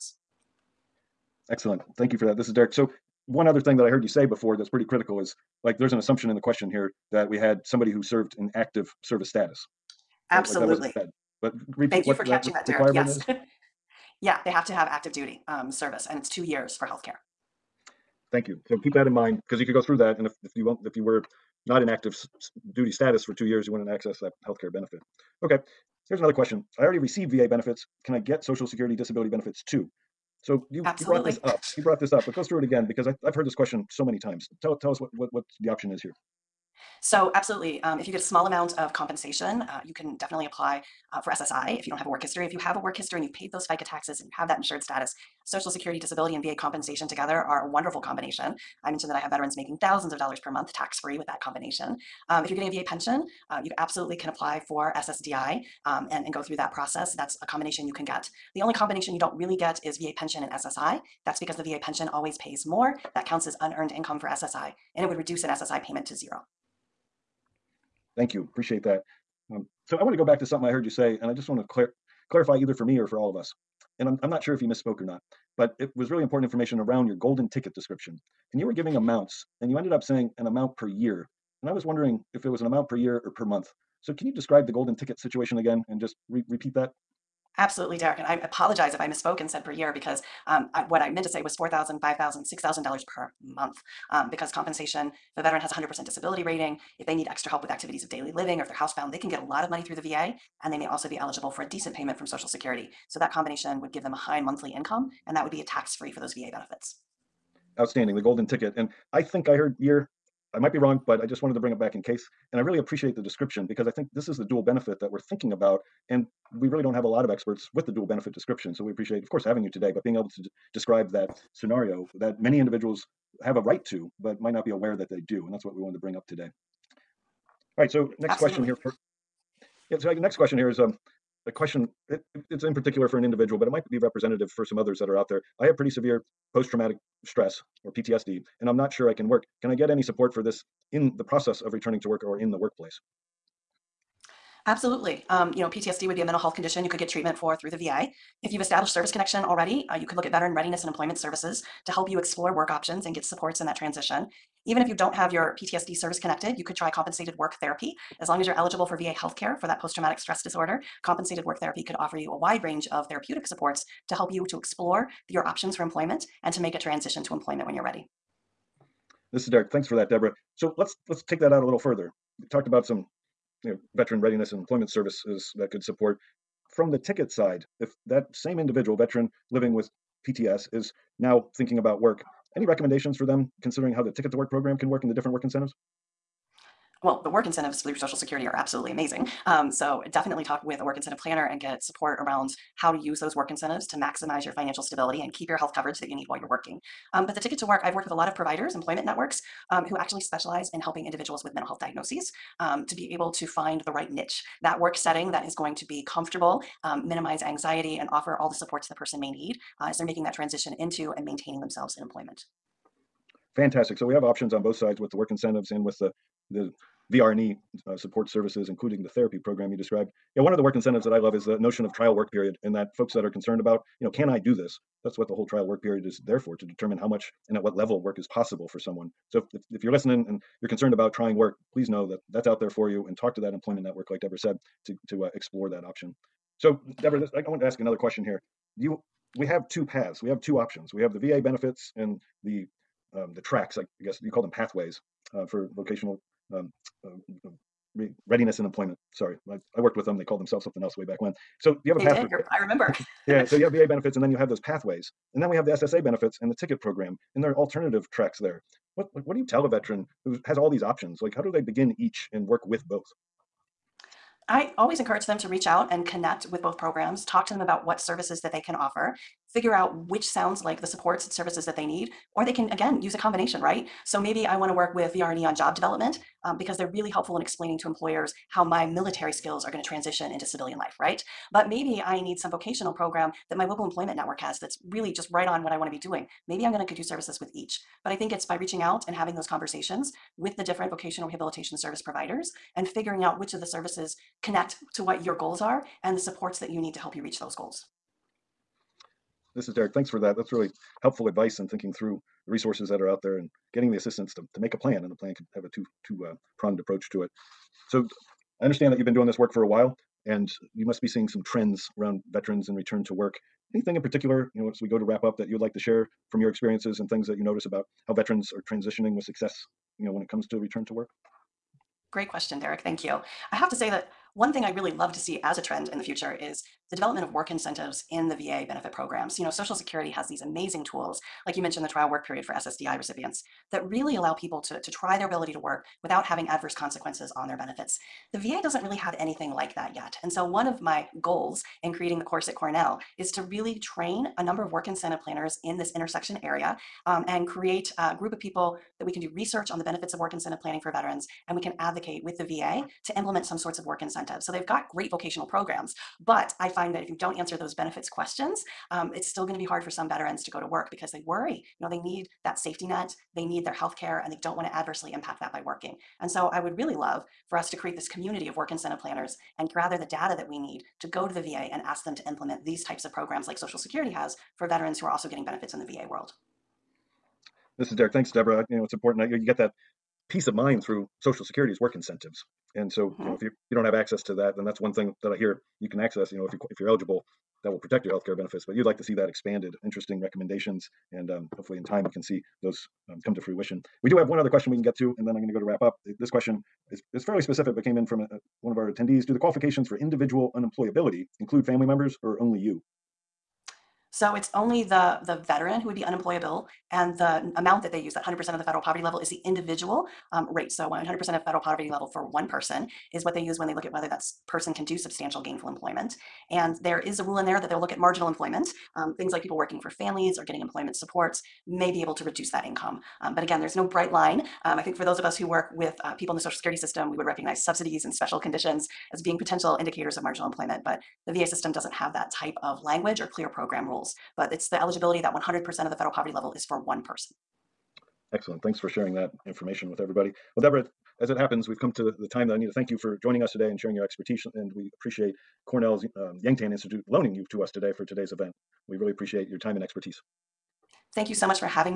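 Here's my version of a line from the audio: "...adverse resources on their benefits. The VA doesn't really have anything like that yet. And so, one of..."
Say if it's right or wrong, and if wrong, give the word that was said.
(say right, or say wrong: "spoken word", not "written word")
wrong: "consequences", not "resources".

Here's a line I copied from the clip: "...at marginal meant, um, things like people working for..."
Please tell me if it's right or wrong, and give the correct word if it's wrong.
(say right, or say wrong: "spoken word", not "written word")
wrong: "employment", not "meant".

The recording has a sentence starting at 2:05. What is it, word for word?
And that's what we wanted to bring up today.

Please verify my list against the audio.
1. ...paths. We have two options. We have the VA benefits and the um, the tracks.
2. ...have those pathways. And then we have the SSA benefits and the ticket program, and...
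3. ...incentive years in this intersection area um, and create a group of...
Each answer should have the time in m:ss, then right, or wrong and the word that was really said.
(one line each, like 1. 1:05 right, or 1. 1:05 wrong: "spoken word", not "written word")
1. 3:59 right
2. 4:14 right
3. 5:44 wrong: "planners", not "years".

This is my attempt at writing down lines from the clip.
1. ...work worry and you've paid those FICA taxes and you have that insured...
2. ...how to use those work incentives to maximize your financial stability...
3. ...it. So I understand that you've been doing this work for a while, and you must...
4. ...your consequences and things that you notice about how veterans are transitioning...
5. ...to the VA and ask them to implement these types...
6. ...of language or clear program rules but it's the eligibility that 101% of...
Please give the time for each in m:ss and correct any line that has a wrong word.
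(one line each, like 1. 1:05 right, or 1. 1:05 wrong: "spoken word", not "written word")
1. 0:42 wrong: "history", not "worry"
2. 3:12 right
3. 5:07 right
4. 5:16 wrong: "experiences", not "consequences"
5. 6:11 right
6. 7:12 wrong: "100", not "101".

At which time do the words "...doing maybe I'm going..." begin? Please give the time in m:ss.
4:45.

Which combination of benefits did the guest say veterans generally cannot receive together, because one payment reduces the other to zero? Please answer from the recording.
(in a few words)
VA pension and SSI.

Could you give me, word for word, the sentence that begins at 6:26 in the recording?
You know, if you if you're eligible, that will protect your health care benefits.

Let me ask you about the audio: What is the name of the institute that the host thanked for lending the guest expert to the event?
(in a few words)
Yang-Tan Institute.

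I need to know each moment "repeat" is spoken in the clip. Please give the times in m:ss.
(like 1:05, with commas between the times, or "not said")
0:11, 1:26.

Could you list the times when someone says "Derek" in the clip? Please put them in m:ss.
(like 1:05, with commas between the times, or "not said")
0:02, 0:12, 1:27, 2:49, 4:59, 5:22, 6:17.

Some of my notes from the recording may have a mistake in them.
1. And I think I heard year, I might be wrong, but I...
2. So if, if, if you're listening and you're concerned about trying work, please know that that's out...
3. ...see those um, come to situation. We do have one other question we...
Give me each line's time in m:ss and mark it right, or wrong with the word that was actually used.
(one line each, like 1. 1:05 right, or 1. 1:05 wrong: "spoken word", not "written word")
1. 1:48 right
2. 3:49 right
3. 6:32 wrong: "fruition", not "situation".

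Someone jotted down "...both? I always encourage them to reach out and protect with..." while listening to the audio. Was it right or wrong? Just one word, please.
wrong.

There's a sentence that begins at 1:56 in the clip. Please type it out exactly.
And we really don't have a lot of experts with the dual benefit description.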